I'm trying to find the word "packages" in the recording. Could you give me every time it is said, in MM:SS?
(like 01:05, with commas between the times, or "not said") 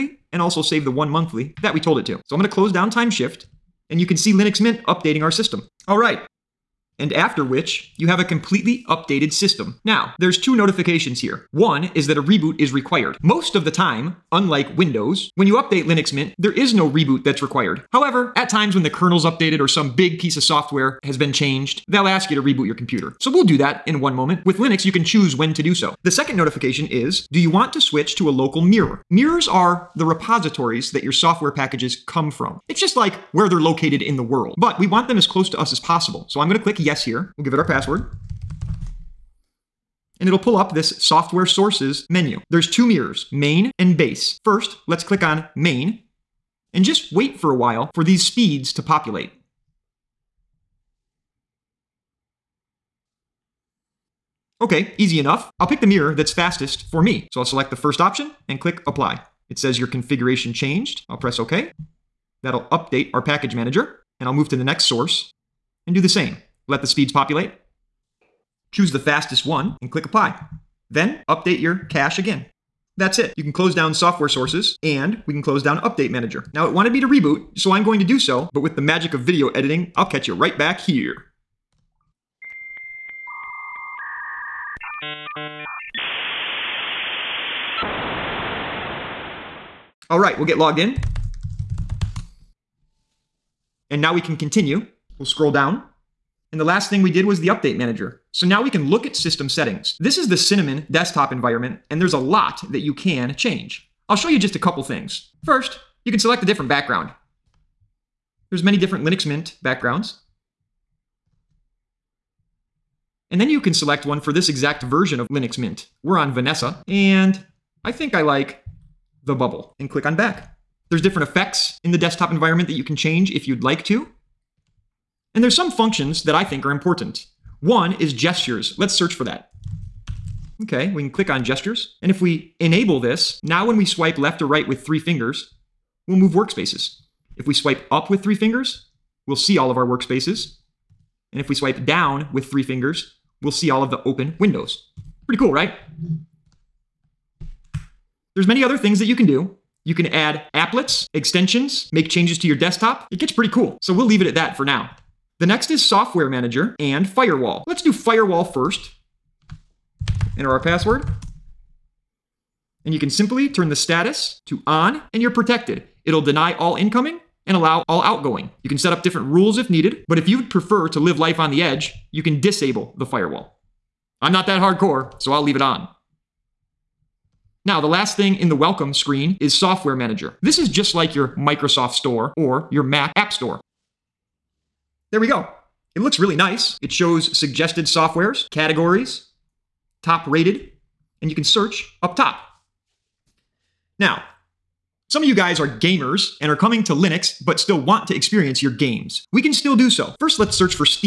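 00:31, 01:03.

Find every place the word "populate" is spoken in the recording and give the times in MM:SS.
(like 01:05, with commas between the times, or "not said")
00:48, 01:07.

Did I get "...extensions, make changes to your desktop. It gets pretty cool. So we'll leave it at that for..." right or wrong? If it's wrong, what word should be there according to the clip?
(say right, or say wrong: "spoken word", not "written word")
right.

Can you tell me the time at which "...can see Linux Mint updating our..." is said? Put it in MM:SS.
00:04.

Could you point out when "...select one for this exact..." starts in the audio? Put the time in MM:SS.
01:53.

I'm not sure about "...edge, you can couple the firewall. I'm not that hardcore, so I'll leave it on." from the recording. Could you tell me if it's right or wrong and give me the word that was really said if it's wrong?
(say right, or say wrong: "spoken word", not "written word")
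wrong: "disable", not "couple".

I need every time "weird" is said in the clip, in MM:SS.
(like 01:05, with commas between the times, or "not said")
not said.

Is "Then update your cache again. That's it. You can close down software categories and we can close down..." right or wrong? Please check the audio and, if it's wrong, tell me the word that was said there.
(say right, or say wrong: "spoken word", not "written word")
wrong: "sources", not "categories".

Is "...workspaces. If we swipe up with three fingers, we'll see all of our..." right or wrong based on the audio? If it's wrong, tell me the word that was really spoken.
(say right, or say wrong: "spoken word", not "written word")
right.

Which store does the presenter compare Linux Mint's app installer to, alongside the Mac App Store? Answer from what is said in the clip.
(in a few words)
Microsoft Store.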